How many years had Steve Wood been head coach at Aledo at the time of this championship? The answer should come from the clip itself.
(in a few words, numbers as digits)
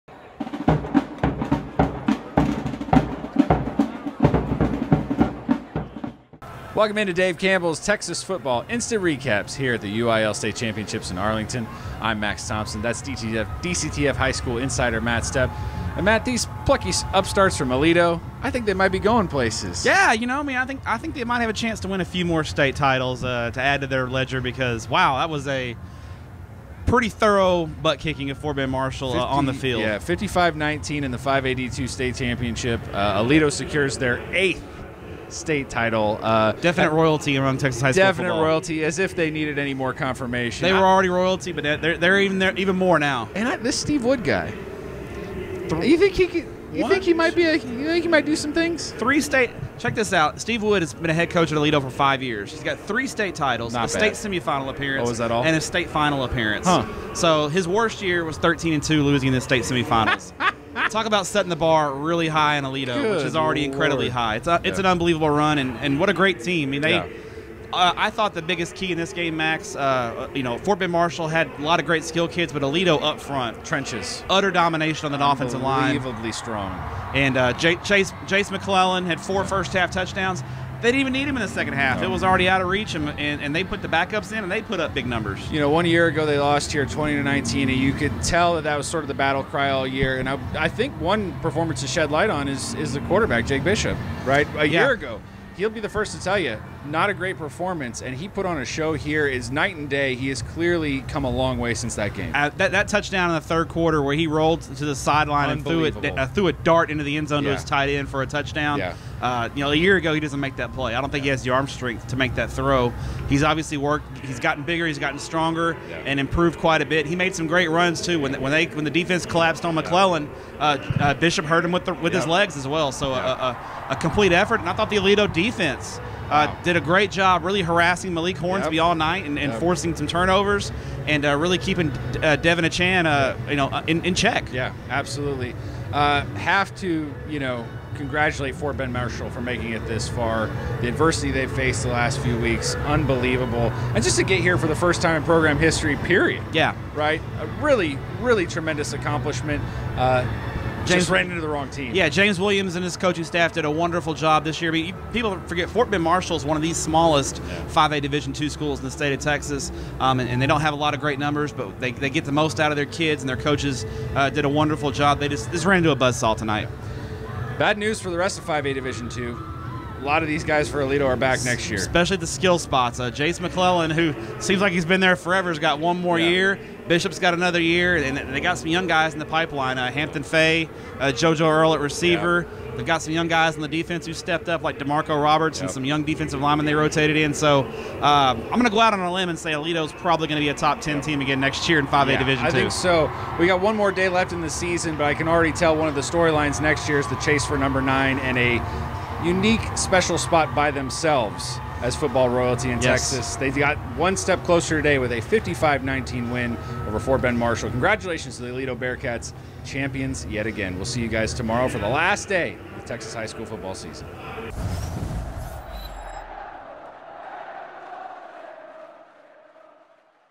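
5.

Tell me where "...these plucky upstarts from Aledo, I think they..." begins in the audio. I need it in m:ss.
0:16.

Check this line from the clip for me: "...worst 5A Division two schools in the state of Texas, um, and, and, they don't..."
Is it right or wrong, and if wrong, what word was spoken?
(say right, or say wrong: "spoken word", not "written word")
wrong: "smallest", not "worst".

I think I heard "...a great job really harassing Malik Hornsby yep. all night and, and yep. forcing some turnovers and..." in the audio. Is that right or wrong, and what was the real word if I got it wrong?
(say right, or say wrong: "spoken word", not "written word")
right.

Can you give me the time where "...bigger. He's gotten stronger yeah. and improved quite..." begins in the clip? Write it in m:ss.
1:54.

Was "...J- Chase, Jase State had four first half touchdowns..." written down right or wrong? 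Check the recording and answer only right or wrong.
wrong.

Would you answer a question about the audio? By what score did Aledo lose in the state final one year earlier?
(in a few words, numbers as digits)
20-19.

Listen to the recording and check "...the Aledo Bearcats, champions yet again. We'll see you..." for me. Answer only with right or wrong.
right.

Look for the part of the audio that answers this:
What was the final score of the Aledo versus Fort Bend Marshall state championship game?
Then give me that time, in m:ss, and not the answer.
0:29.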